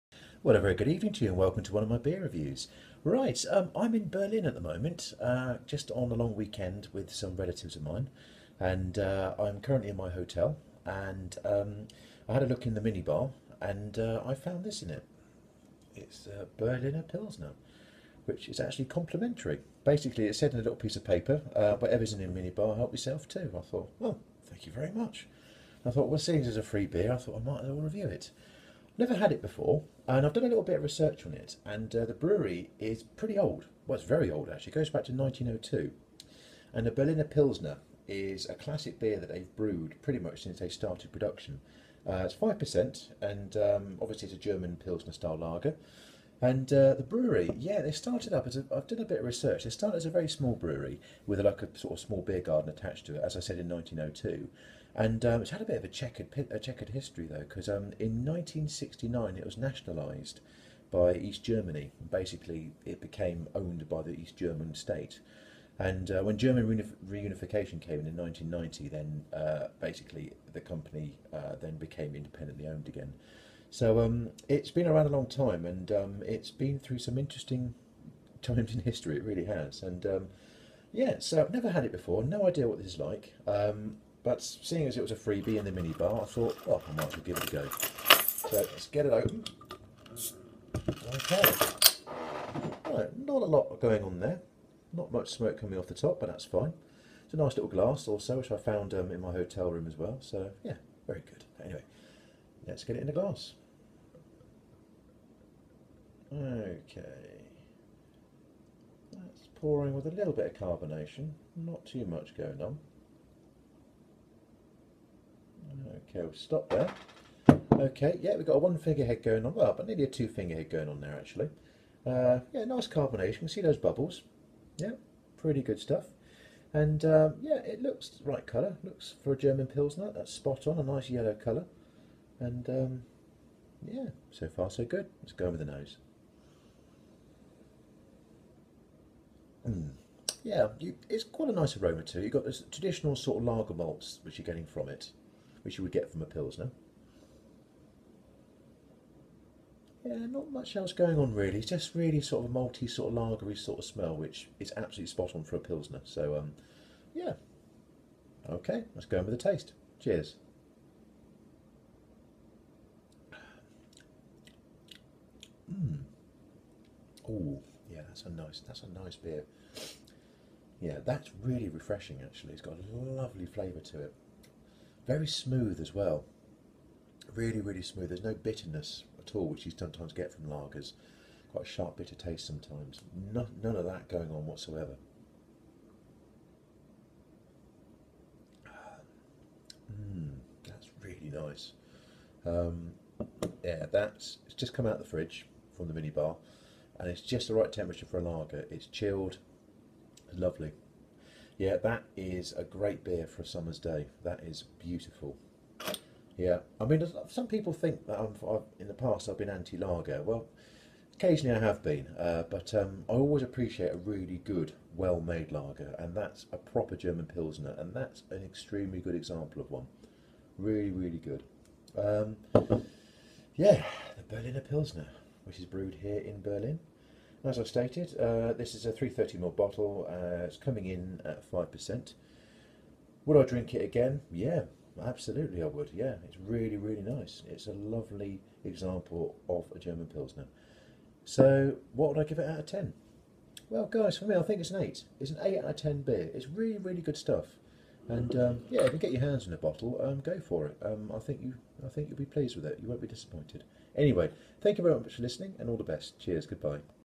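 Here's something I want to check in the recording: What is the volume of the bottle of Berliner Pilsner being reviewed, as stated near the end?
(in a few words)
330ml.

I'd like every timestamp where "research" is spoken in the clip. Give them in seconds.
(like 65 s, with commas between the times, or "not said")
30 s, 49 s.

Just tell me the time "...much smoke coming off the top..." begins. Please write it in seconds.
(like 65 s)
95 s.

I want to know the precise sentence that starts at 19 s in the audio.
Basically, it said in a little piece of paper, uh, whatever's in the minibar, help yourself too.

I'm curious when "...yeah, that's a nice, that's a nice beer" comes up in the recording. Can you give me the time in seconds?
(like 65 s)
167 s.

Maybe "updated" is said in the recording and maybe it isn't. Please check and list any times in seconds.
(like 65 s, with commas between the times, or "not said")
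not said.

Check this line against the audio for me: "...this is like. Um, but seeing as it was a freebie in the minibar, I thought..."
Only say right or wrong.
right.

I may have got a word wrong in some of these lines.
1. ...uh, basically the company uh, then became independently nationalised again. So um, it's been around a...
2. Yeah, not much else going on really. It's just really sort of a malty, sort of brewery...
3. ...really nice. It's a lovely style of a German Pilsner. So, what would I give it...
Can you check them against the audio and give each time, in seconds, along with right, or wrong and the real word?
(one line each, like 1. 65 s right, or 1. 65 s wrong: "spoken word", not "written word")
1. 69 s wrong: "owned", not "nationalised"
2. 150 s wrong: "lagery", not "brewery"
3. 236 s wrong: "example", not "style".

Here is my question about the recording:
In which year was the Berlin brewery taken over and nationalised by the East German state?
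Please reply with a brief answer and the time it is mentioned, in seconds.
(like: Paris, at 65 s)
1969, at 58 s.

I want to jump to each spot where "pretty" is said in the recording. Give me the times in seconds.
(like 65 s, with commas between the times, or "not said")
33 s, 40 s, 125 s.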